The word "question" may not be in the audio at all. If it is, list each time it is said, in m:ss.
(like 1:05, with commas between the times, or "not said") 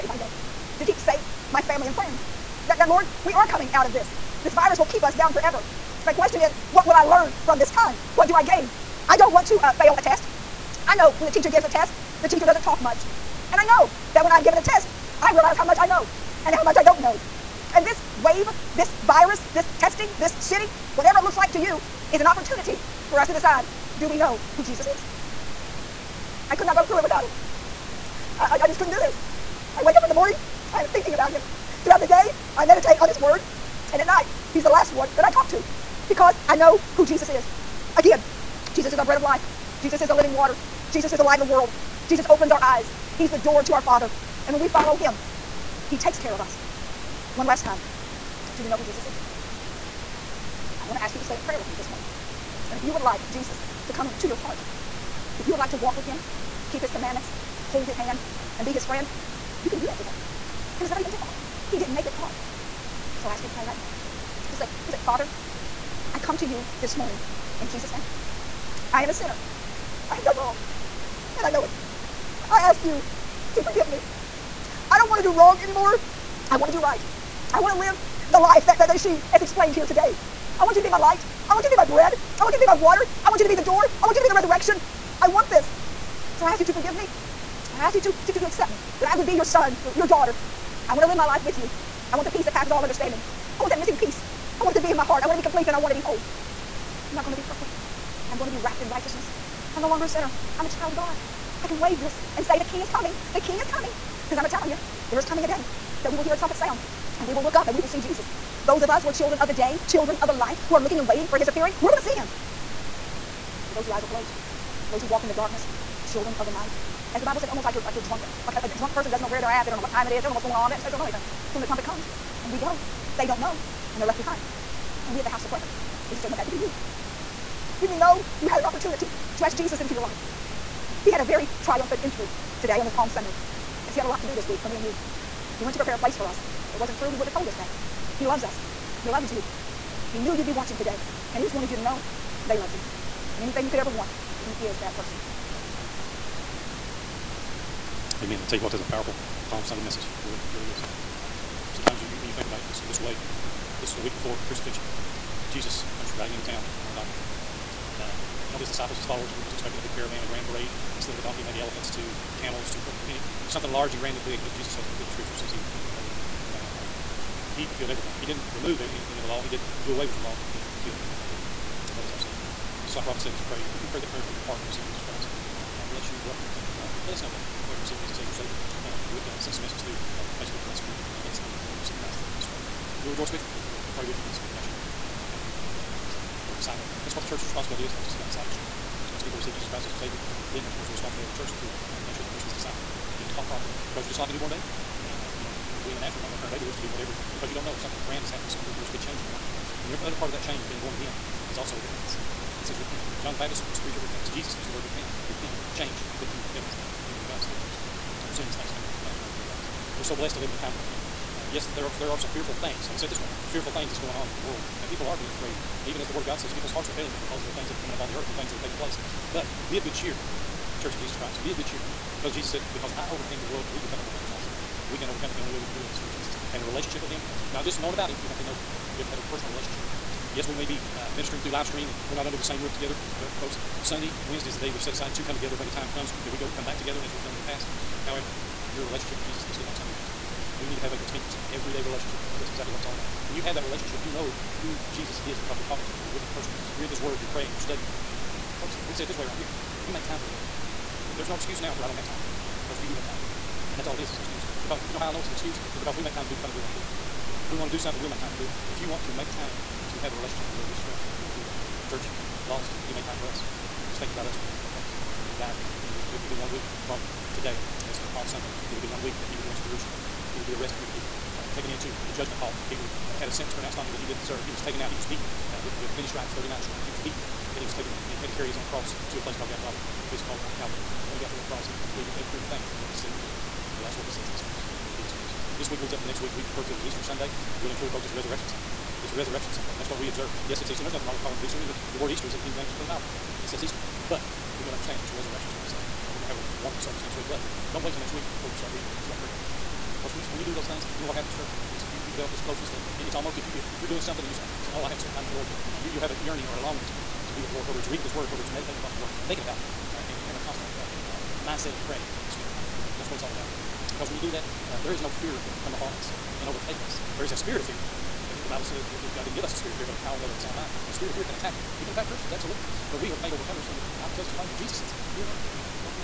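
0:06.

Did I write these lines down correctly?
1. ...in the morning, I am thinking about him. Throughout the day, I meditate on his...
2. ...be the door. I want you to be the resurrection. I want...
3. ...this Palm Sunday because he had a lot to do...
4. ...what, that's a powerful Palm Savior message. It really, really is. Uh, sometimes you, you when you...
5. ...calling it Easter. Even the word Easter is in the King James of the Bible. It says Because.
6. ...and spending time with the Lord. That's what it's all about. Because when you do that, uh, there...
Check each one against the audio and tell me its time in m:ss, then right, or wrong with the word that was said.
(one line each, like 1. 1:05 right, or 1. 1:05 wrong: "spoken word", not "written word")
1. 0:30 right
2. 1:23 right
3. 2:12 right
4. 2:28 wrong: "Sunday", not "Savior"
5. 4:51 wrong: "Easter", not "Because"
6. 5:12 right.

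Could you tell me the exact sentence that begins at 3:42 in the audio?
Because Jesus said, Because I overcame the world, we become overcomers also.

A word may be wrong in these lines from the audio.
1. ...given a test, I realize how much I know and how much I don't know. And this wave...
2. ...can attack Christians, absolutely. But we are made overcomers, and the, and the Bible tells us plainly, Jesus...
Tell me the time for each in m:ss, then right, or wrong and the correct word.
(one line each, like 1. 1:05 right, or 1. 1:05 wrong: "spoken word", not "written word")
1. 0:14 right
2. 5:21 right.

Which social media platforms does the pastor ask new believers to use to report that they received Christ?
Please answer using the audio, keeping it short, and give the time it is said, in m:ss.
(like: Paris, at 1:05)
Facebook or Messenger, at 3:00.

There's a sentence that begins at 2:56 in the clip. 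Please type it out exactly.
Welcome to the kingdom of God.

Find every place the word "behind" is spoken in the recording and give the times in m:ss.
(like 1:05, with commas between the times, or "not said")
2:04.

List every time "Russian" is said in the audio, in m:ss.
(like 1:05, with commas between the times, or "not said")
not said.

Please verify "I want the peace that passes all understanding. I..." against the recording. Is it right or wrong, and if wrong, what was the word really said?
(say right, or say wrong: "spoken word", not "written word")
right.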